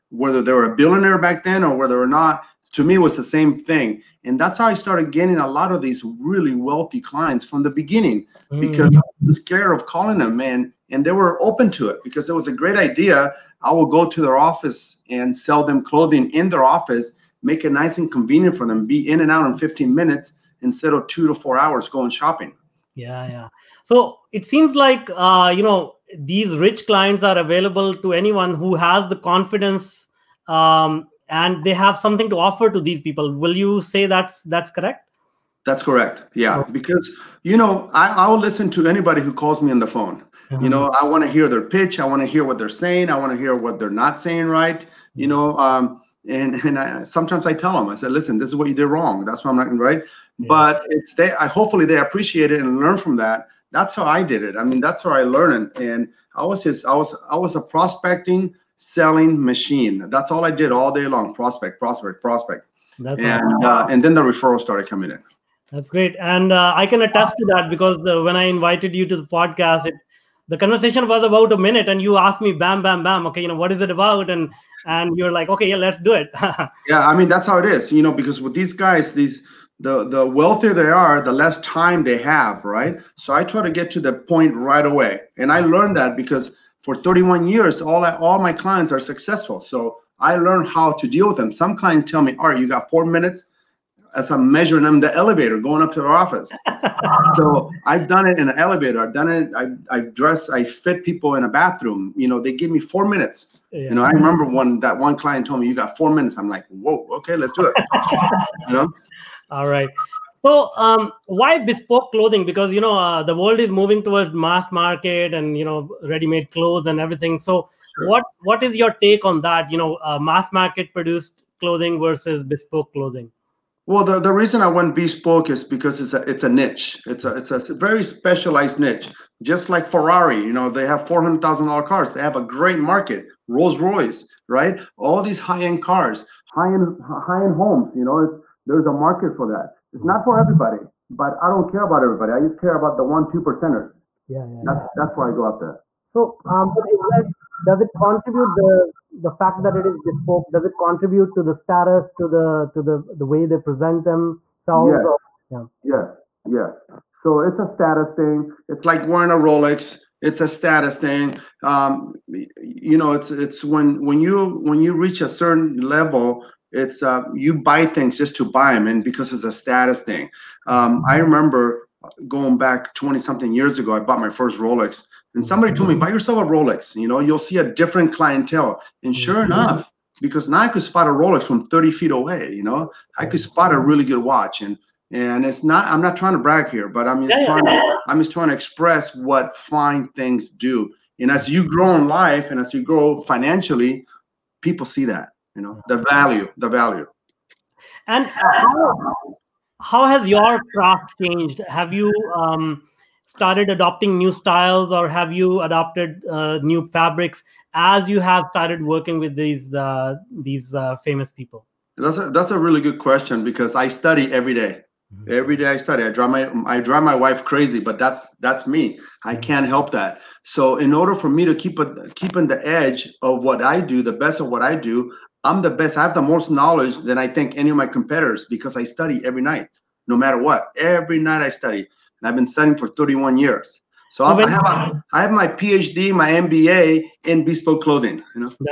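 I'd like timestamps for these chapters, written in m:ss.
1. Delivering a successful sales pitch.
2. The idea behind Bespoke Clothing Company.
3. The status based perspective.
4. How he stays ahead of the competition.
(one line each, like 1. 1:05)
1. 0:36
2. 2:04
3. 2:35
4. 3:32.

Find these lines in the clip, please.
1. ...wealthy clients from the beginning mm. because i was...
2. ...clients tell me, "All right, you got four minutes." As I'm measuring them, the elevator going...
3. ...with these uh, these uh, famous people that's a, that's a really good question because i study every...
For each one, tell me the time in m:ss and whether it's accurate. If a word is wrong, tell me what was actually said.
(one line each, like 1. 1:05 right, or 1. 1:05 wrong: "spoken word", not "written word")
1. 0:06 right
2. 1:31 right
3. 3:29 right.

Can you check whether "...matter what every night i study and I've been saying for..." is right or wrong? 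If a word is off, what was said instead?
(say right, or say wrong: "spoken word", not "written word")
wrong: "studying", not "saying".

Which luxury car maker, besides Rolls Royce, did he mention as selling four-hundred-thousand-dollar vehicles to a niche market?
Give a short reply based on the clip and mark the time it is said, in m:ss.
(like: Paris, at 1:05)
Ferrari, at 2:09.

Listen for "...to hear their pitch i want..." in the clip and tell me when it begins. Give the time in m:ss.
0:41.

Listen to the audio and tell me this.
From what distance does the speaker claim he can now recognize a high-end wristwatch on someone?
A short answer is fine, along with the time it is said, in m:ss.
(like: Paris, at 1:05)
30 feet, at 3:01.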